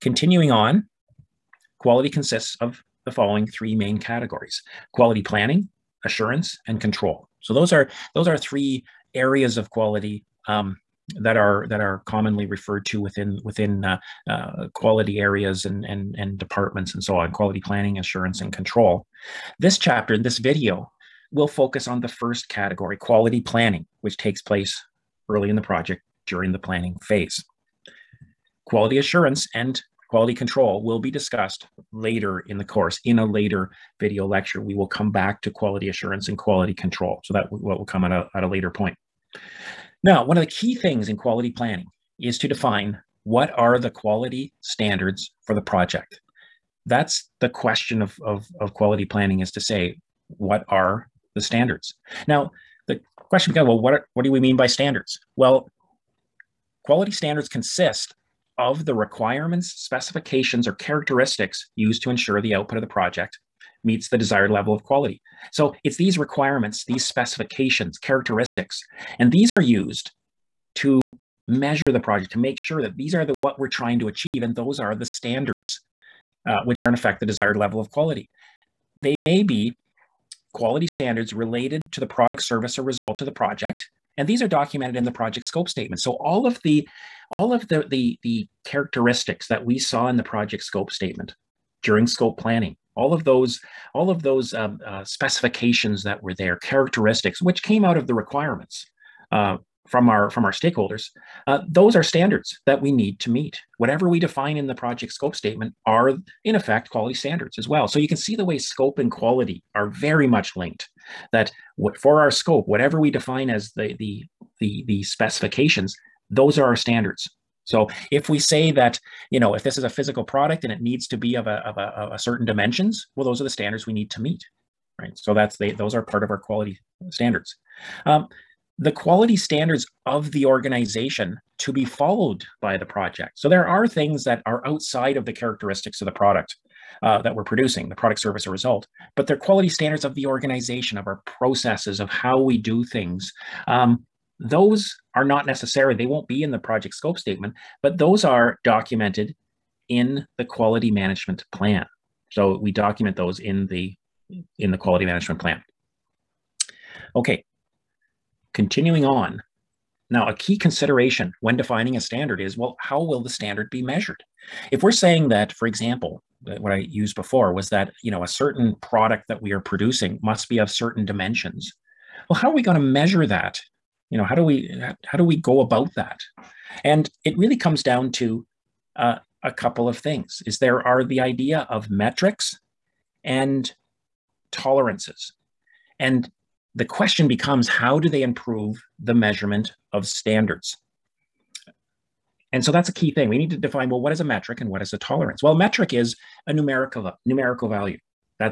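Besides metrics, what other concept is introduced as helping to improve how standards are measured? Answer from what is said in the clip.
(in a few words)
Tolerances.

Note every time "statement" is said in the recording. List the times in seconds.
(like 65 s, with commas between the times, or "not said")
85 s, 90 s, 105 s, 147 s.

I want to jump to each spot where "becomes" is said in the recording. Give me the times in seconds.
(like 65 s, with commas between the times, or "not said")
53 s, 187 s.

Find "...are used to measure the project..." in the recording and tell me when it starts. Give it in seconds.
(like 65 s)
69 s.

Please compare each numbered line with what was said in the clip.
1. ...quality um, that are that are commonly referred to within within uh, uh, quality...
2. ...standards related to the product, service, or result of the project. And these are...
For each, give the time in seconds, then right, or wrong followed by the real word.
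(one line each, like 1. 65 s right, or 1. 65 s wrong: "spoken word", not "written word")
1. 9 s right
2. 80 s right.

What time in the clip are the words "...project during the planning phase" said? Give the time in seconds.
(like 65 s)
25 s.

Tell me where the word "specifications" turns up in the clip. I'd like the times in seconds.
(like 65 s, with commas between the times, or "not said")
59 s, 67 s, 95 s, 115 s.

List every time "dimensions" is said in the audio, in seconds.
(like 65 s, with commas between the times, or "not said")
122 s, 171 s.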